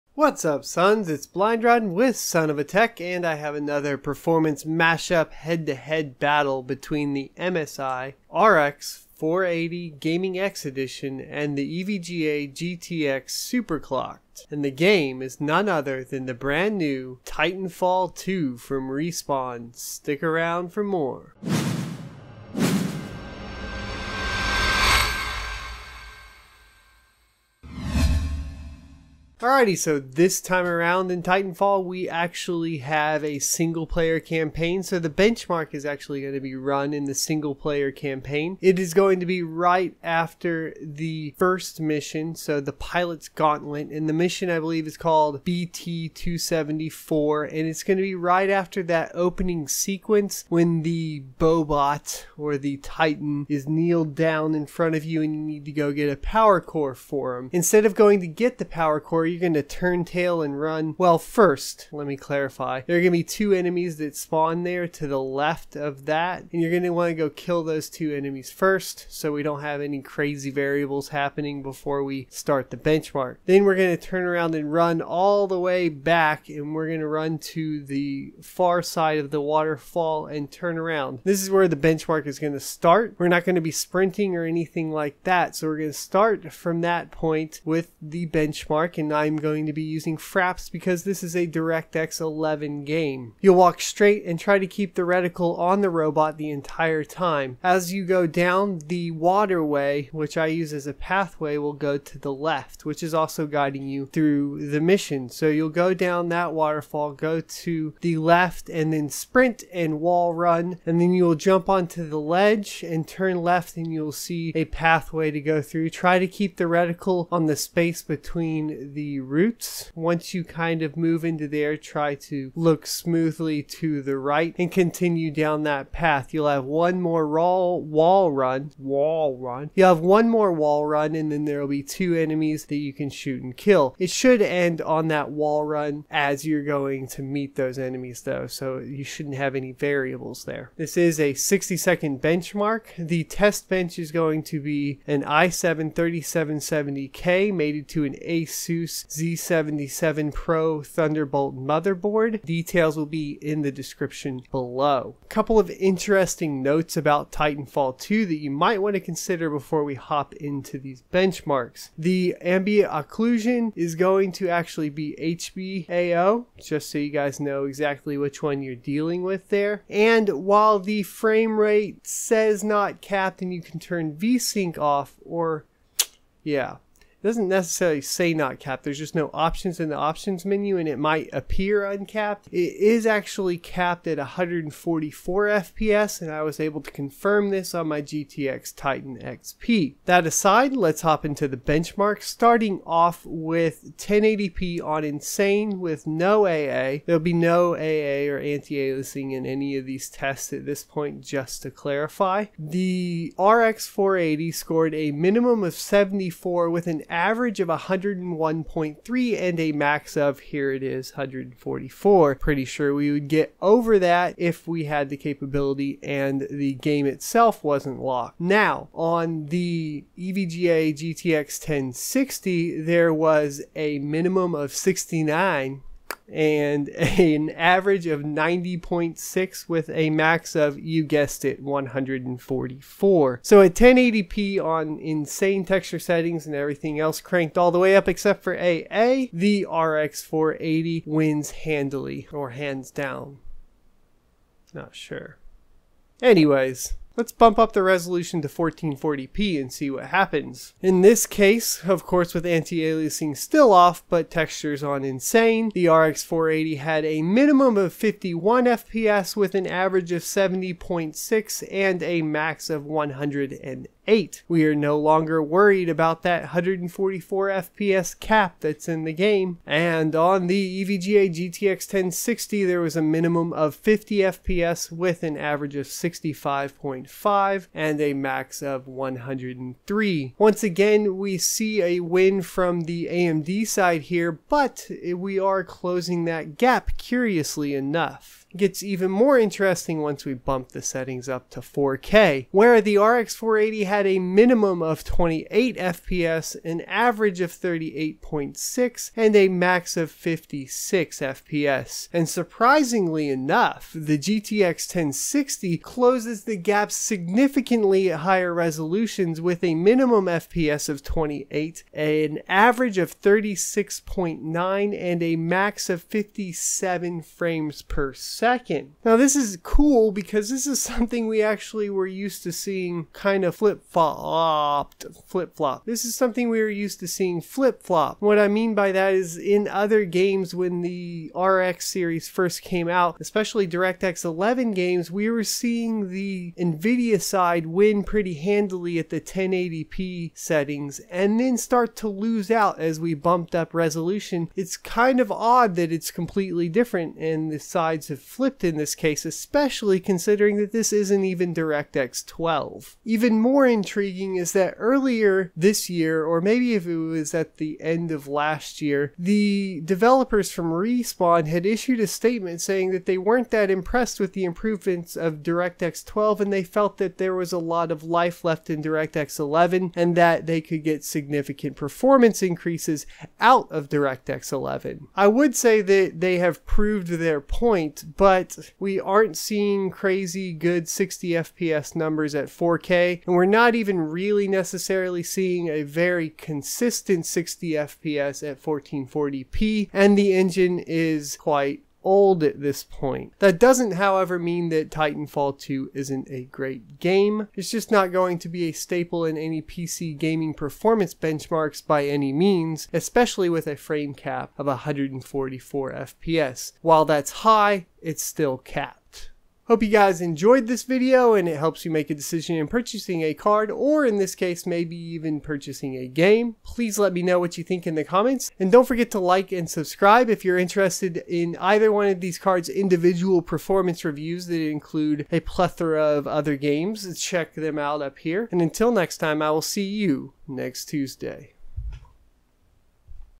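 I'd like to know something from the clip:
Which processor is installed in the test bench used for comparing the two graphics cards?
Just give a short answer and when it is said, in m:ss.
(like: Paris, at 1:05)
i7 3770K, at 2:25.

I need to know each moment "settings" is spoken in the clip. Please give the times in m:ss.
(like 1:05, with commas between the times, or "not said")
3:55, 4:50, 5:40.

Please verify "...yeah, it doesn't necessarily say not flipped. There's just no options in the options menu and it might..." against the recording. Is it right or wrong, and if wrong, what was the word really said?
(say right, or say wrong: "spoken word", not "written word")
wrong: "capped", not "flipped".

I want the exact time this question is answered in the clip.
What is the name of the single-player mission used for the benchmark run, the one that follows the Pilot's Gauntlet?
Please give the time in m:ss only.
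0:45.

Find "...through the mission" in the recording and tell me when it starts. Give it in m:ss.
1:44.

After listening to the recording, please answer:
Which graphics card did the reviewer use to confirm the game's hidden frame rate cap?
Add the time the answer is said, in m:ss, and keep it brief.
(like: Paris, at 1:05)
GTX Titan XP, at 3:08.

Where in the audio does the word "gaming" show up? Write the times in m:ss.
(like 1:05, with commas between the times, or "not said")
0:09, 6:40.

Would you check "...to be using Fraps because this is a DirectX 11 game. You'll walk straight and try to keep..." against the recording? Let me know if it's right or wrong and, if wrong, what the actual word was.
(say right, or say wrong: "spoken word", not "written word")
right.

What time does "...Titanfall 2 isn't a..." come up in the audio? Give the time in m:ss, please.
6:34.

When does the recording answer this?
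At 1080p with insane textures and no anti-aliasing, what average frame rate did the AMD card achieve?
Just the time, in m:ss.
3:27.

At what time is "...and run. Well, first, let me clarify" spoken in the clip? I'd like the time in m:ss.
1:00.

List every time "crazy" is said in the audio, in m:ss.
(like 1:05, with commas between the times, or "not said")
1:10, 6:19.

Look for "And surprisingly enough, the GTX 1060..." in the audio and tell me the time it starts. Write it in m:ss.
5:02.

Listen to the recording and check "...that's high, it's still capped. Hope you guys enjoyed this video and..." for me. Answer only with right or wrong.
right.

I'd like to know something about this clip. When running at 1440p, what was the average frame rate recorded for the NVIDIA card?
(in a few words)
65.5.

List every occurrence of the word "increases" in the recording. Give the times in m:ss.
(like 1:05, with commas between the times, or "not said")
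6:12.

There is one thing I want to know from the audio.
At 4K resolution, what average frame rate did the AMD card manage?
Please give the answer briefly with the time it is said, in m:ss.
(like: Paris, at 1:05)
38.6, at 4:57.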